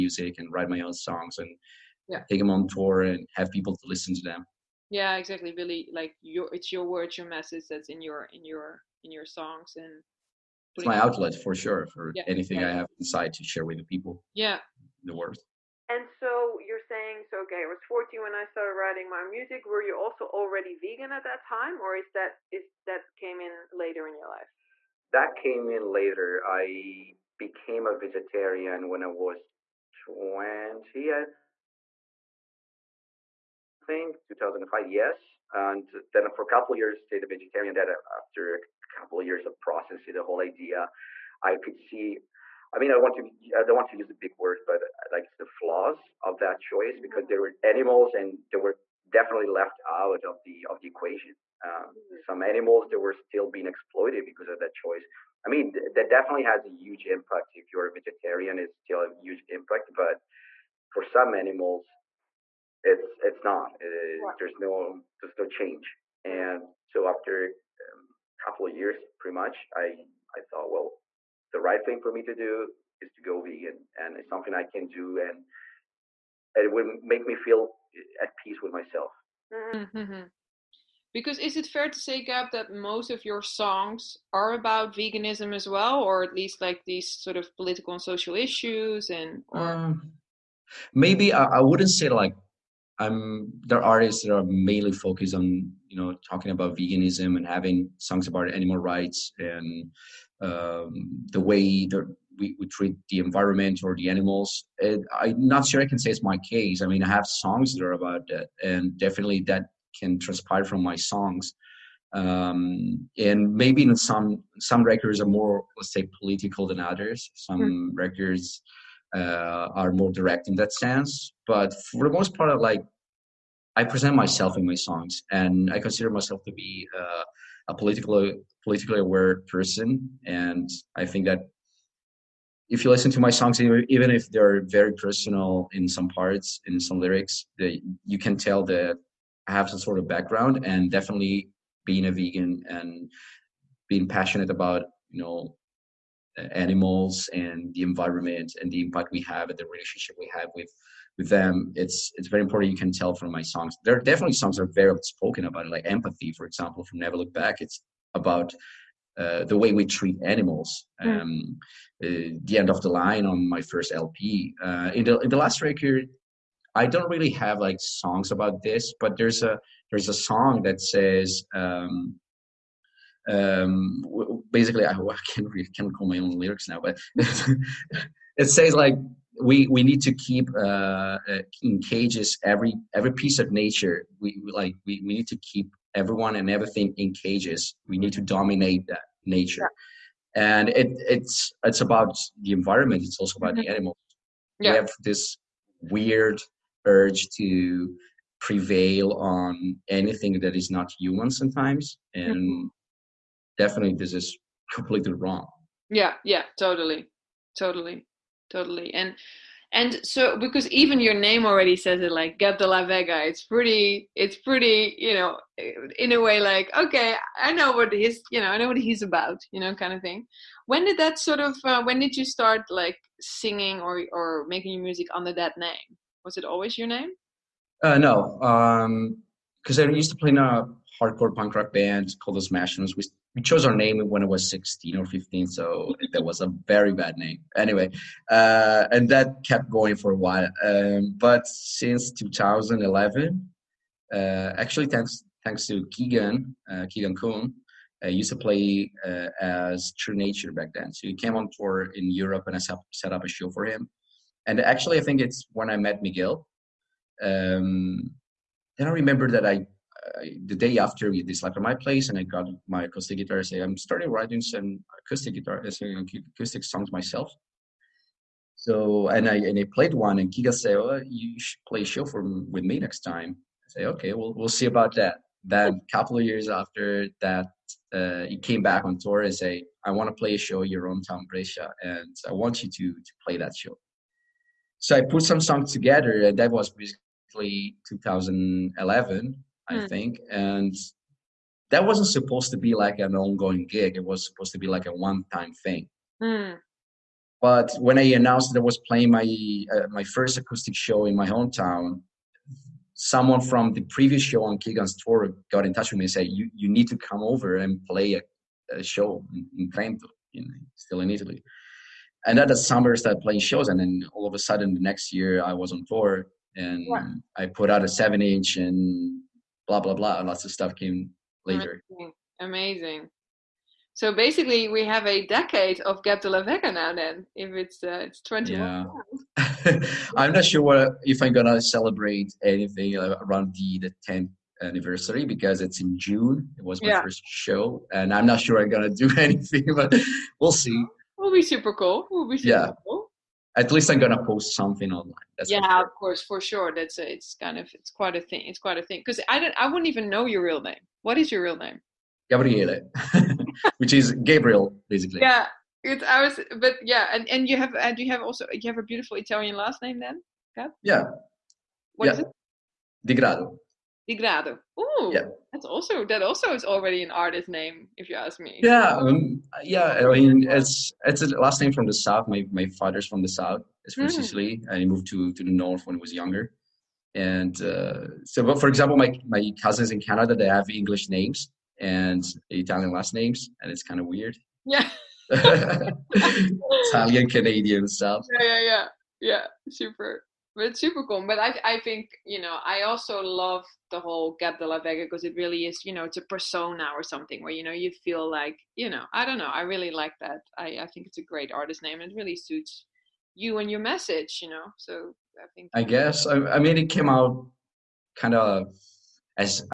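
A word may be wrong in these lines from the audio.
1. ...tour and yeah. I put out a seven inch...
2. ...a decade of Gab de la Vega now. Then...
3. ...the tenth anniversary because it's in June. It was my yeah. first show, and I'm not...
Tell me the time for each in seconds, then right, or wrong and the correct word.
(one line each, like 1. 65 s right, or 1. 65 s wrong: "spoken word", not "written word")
1. 315 s right
2. 325 s right
3. 333 s right.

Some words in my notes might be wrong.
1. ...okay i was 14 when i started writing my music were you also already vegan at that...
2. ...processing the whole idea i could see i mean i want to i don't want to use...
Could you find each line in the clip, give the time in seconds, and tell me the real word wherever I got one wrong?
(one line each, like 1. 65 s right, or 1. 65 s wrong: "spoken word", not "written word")
1. 17 s right
2. 39 s right.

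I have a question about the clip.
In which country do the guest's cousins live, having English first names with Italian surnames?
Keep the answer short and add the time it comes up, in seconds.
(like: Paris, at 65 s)
Canada, at 379 s.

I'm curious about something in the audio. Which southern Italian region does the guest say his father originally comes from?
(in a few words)
Sicily.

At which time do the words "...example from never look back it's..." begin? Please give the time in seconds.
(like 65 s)
156 s.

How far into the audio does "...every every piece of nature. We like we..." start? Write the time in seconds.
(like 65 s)
182 s.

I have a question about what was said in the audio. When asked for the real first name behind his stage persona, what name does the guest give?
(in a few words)
Gabriele.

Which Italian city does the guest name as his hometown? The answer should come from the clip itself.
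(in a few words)
Brescia.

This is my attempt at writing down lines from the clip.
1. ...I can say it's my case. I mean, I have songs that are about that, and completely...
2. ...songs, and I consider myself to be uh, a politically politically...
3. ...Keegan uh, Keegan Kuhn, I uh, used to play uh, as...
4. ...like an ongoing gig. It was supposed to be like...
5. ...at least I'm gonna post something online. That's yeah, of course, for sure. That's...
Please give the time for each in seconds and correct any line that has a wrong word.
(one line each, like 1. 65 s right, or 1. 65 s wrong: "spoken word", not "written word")
1. 105 s wrong: "definitely", not "completely"
2. 124 s right
3. 245 s right
4. 292 s right
5. 343 s right.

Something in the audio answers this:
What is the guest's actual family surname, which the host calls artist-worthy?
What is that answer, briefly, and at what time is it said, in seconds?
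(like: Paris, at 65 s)
Di Grado, at 363 s.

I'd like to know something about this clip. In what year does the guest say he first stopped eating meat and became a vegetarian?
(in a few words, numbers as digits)
2005.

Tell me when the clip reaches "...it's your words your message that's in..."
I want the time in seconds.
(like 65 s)
6 s.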